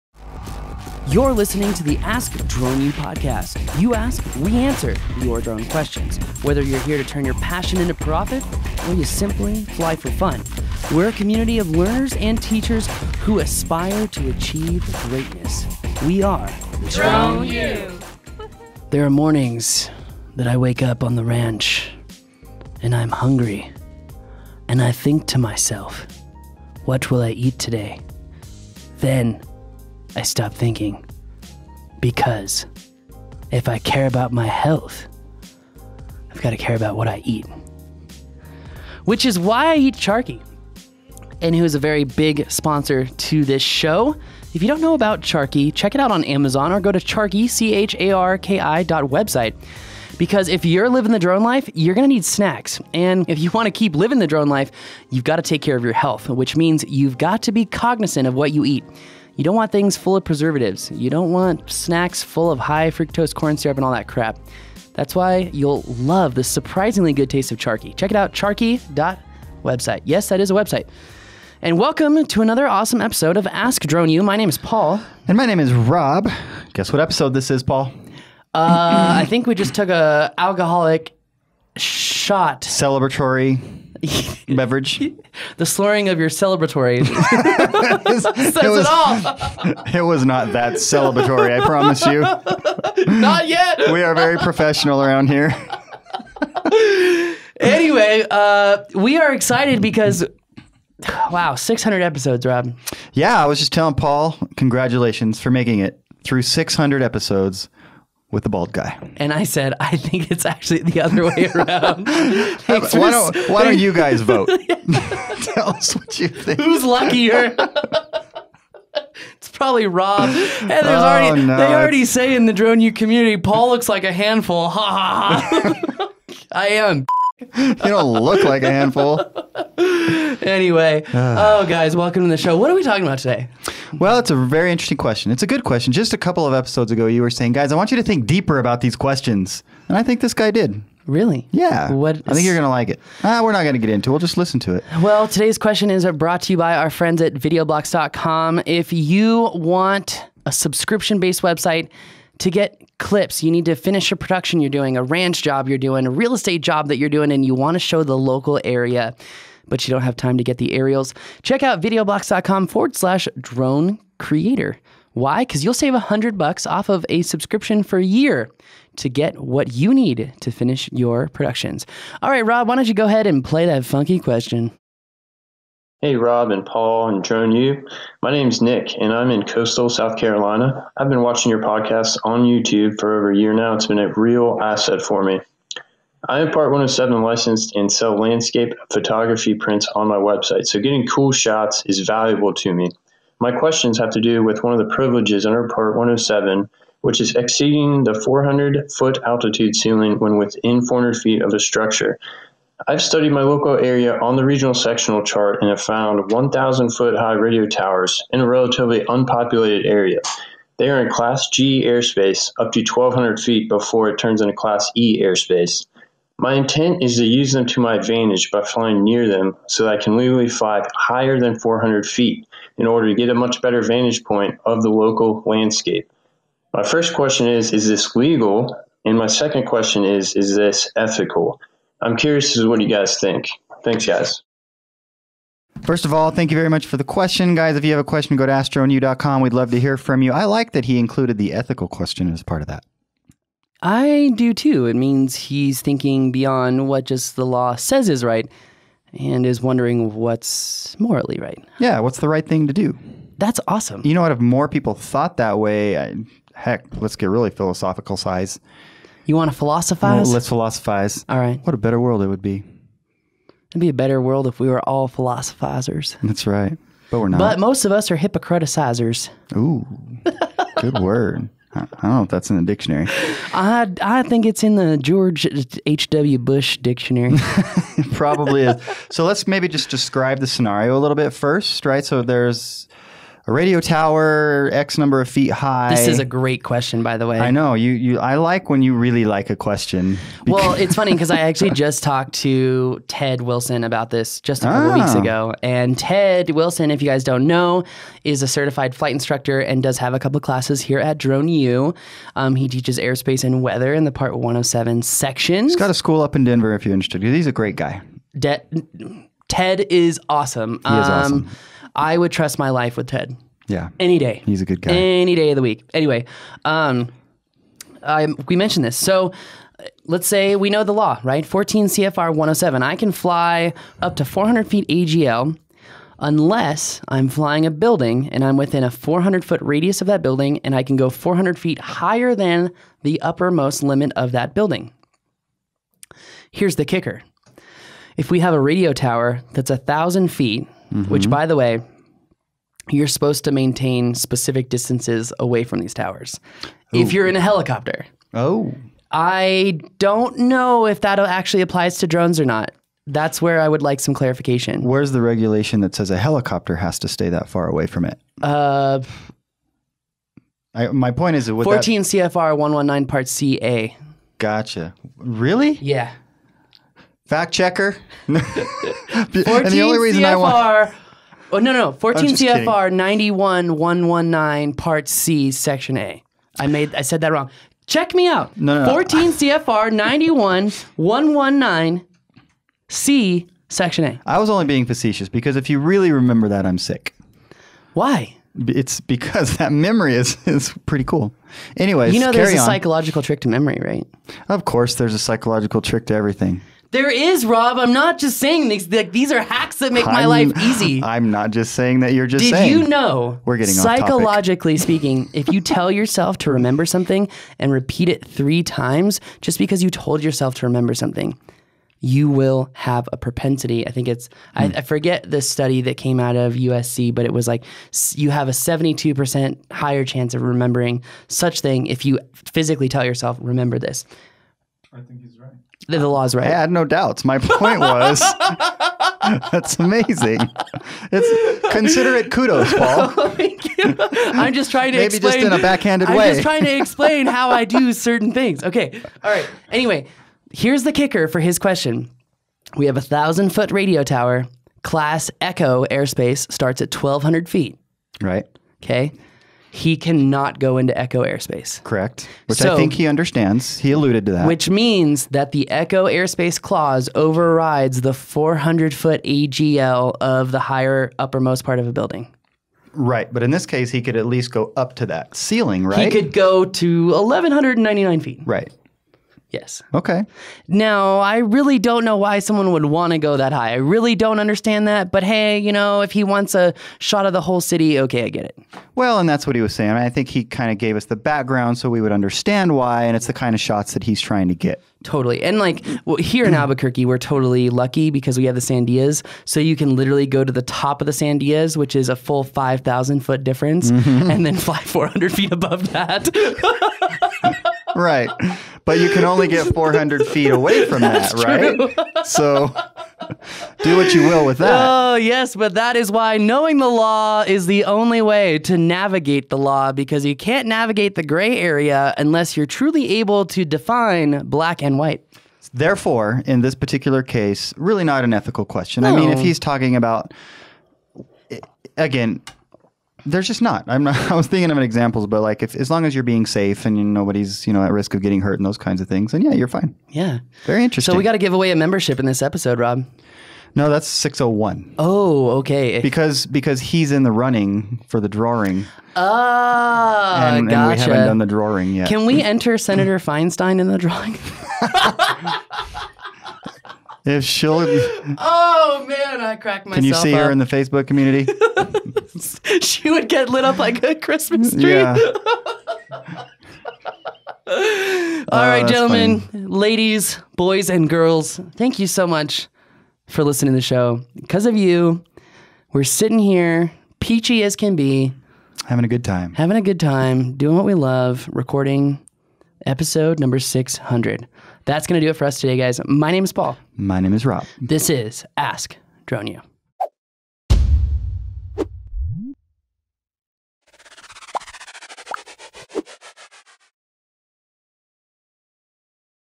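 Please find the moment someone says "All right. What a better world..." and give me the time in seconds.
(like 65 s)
261 s.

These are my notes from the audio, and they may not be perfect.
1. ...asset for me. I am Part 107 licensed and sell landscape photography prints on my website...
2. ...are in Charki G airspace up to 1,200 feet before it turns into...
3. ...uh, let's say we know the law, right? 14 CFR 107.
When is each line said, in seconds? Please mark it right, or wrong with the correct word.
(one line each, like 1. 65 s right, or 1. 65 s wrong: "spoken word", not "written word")
1. 184 s right
2. 210 s wrong: "Class", not "Charki"
3. 319 s right.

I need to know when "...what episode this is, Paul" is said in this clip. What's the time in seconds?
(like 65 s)
76 s.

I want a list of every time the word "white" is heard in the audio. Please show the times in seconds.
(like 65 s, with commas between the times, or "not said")
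514 s.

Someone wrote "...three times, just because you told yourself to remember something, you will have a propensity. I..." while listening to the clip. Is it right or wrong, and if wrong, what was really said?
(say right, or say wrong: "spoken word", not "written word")
right.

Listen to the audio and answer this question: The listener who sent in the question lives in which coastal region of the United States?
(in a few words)
coastal South Carolina.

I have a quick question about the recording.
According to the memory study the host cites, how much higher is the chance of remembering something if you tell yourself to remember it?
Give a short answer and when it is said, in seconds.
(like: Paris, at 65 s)
72%, at 418 s.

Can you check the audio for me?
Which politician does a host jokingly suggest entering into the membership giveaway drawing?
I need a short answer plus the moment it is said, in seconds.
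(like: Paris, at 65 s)
Senator Feinstein, at 542 s.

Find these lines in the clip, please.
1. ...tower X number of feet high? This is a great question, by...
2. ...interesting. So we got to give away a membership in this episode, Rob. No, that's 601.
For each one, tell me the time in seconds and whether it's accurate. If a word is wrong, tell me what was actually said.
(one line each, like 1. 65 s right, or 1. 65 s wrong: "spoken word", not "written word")
1. 283 s right
2. 530 s right.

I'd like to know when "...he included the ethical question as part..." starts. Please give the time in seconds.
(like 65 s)
240 s.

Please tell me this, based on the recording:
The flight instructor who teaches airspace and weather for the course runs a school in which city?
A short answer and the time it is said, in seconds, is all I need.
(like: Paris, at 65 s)
Denver, at 306 s.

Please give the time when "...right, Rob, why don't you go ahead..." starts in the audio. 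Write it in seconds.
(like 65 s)
172 s.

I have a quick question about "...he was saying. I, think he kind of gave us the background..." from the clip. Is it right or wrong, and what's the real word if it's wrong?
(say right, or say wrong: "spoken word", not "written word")
right.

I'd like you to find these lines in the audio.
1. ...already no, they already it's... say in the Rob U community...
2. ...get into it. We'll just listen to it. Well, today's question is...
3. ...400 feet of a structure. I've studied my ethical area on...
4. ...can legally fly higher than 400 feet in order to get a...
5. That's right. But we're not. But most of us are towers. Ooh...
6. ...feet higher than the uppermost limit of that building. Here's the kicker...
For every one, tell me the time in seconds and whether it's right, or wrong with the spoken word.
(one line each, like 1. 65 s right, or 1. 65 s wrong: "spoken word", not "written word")
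1. 121 s wrong: "Drone", not "Rob"
2. 143 s right
3. 200 s wrong: "local", not "ethical"
4. 220 s right
5. 266 s wrong: "hypocriticizers", not "towers"
6. 331 s right.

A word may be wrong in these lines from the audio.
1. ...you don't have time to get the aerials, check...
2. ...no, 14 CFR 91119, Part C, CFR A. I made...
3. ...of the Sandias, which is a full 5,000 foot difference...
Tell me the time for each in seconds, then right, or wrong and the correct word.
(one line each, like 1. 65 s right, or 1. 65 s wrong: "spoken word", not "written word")
1. 159 s right
2. 371 s wrong: "Section", not "CFR"
3. 491 s right.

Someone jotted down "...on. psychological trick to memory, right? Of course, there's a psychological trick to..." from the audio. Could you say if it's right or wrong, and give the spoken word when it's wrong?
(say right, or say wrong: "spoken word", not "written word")
right.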